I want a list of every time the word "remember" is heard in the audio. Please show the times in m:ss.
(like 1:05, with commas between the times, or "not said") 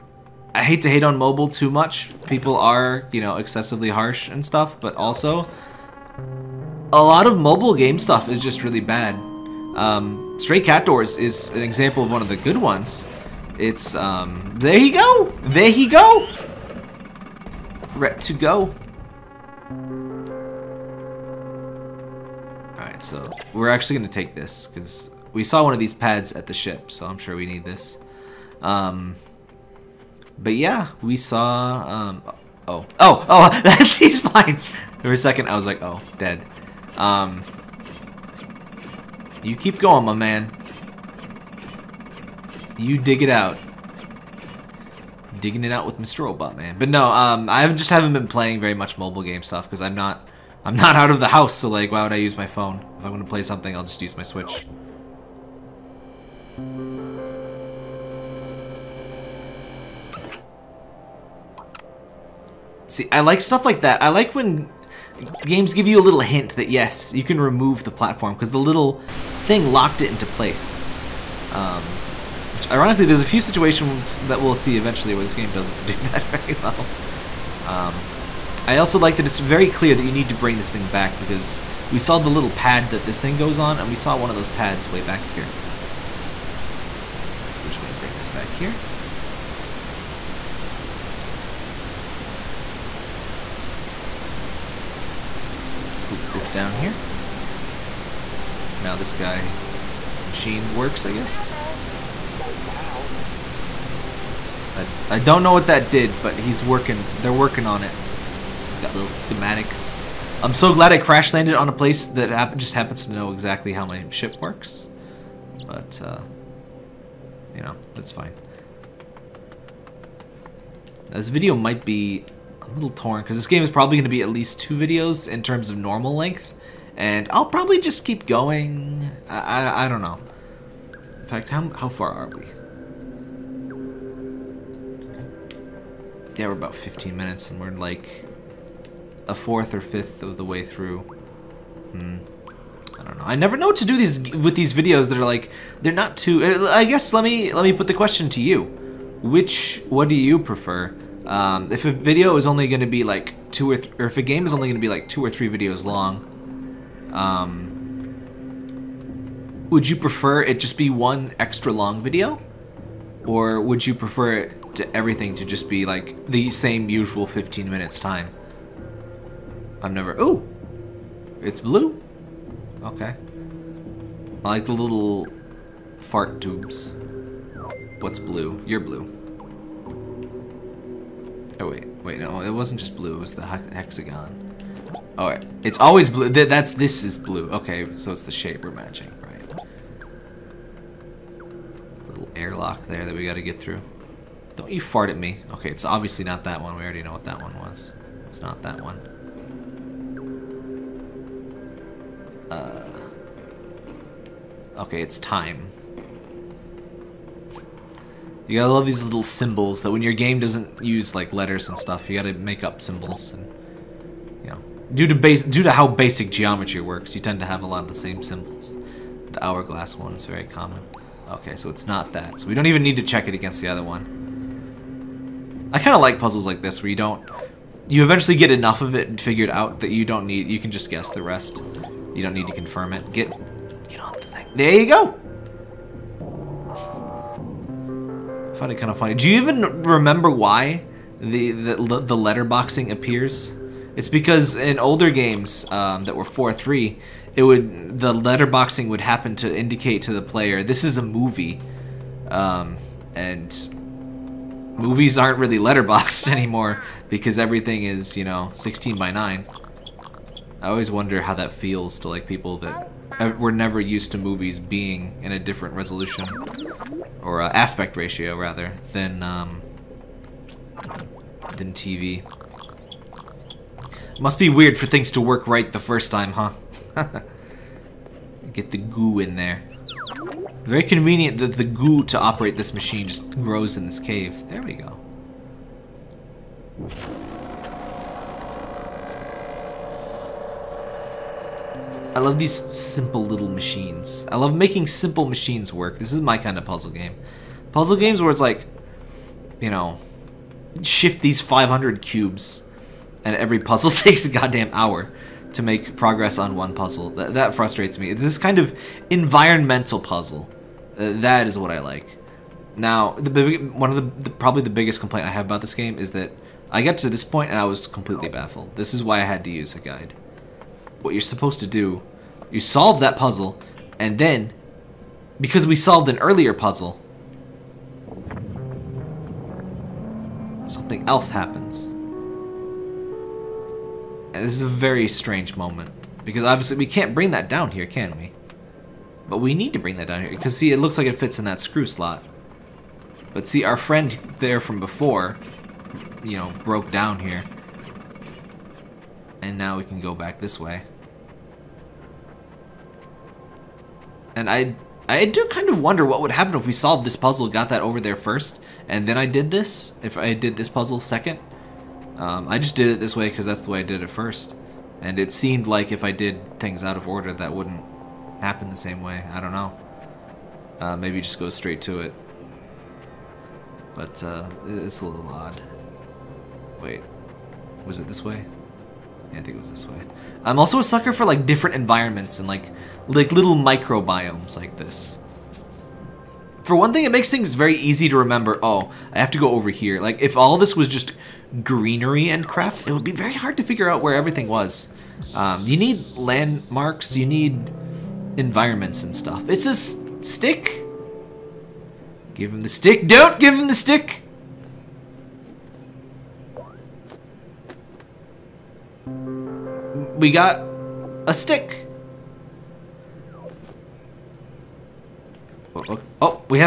3:59, 6:28.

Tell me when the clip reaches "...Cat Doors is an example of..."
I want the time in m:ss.
0:10.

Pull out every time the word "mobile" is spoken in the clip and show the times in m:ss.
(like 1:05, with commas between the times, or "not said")
0:01, 0:07, 0:48.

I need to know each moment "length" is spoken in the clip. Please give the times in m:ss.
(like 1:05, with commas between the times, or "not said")
2:06.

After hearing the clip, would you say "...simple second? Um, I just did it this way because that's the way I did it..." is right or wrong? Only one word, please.
wrong.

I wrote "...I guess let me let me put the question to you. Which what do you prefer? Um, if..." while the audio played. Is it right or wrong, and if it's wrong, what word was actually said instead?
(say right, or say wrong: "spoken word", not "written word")
right.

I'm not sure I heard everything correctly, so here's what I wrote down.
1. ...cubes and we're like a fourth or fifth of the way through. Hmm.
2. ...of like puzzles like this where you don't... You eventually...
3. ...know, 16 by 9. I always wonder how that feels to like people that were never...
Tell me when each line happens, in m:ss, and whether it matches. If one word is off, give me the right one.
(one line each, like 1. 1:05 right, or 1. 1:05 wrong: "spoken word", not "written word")
1. 2:17 wrong: "minutes", not "cubes"
2. 3:45 right
3. 4:18 right.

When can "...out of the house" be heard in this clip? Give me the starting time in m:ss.
0:50.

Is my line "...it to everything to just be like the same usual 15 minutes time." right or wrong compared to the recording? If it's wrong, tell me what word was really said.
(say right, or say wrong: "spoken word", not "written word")
right.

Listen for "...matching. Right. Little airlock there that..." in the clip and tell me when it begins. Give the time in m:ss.
3:08.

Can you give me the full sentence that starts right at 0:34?
For a second, I was like, oh, dead.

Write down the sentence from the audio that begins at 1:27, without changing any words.
So we're just going to bring this back here.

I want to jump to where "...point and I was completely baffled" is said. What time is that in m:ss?
5:17.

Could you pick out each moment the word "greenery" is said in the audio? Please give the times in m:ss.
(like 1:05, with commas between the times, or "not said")
6:31.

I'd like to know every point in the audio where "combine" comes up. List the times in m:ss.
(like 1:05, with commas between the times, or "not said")
not said.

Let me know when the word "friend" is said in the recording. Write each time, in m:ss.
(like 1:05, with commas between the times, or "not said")
5:43.